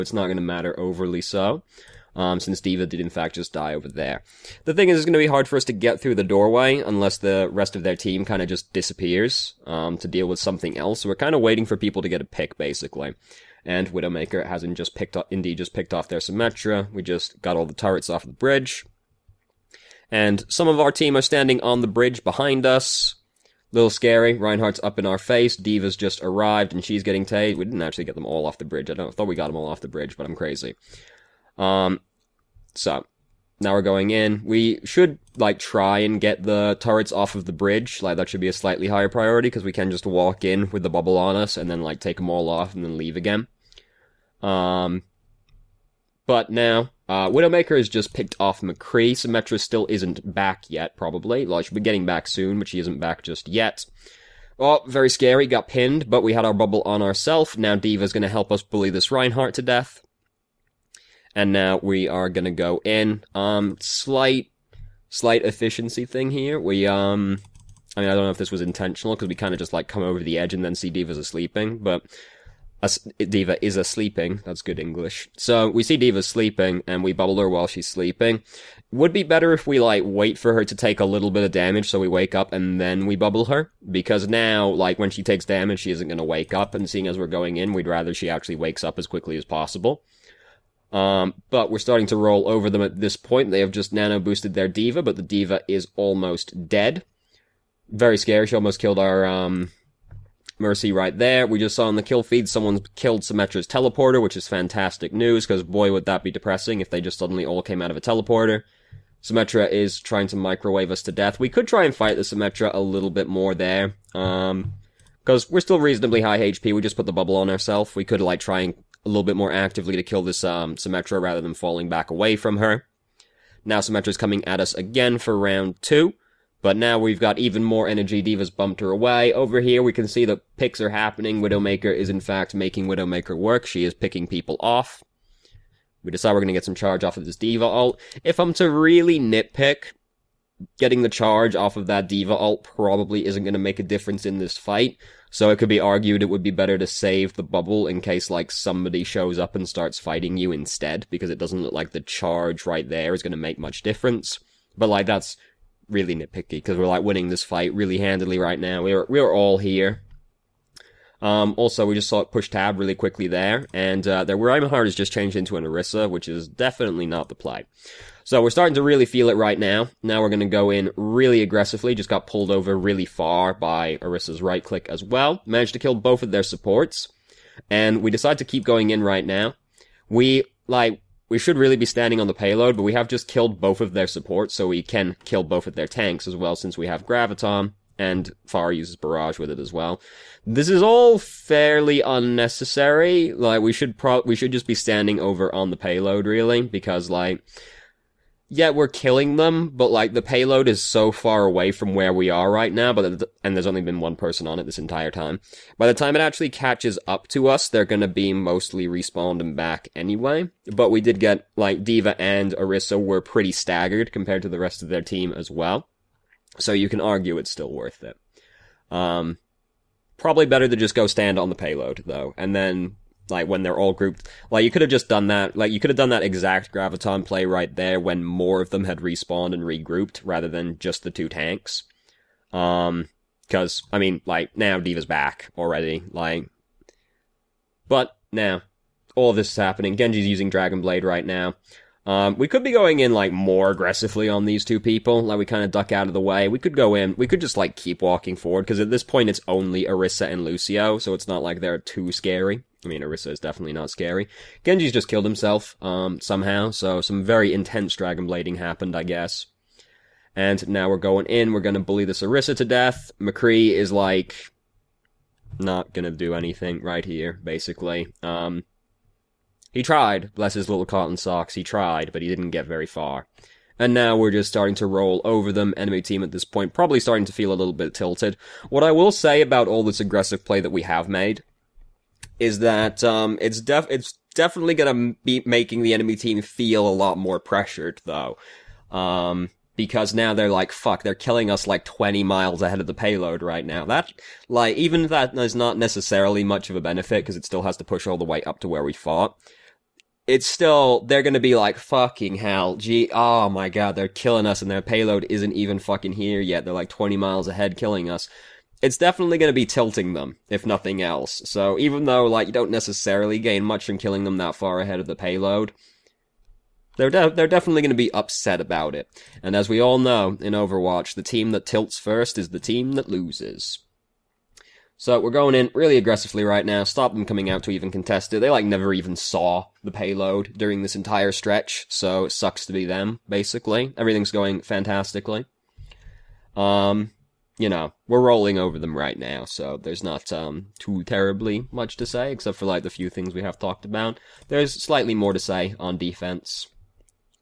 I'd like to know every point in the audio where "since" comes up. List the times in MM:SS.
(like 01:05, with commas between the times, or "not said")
00:02, 03:06.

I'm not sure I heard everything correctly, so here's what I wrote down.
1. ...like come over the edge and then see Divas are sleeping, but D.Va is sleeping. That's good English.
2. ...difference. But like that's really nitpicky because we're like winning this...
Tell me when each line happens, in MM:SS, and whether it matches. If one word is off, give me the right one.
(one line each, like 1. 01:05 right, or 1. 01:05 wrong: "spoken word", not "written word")
1. 01:09 right
2. 02:33 right.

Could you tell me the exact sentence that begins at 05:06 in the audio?
They're like 20 miles ahead killing us it's definitely going to be tilting them, if nothing else.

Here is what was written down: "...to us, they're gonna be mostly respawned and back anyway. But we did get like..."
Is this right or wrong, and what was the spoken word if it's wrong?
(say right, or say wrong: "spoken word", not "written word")
right.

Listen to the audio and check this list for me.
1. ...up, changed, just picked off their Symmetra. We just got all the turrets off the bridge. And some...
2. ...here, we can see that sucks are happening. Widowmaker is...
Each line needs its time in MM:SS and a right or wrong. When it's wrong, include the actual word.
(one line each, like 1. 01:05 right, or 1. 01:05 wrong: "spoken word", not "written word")
1. 00:15 wrong: "indeed", not "changed"
2. 02:09 wrong: "picks", not "sucks".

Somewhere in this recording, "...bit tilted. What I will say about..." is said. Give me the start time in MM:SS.
04:37.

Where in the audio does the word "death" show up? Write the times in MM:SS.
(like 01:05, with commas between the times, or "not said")
00:59, 01:51, 04:22.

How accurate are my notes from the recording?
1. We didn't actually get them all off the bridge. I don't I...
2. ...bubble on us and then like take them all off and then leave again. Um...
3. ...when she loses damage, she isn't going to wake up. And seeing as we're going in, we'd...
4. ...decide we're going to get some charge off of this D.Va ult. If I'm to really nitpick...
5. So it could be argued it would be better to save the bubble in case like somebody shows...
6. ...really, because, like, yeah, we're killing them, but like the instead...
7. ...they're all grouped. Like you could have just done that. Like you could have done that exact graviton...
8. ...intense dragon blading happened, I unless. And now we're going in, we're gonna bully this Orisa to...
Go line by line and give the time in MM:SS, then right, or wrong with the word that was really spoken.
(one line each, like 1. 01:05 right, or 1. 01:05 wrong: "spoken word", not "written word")
1. 00:27 right
2. 00:40 right
3. 01:24 wrong: "takes", not "loses"
4. 02:16 right
5. 02:25 right
6. 03:16 wrong: "payload", not "instead"
7. 03:43 right
8. 04:17 wrong: "guess", not "unless".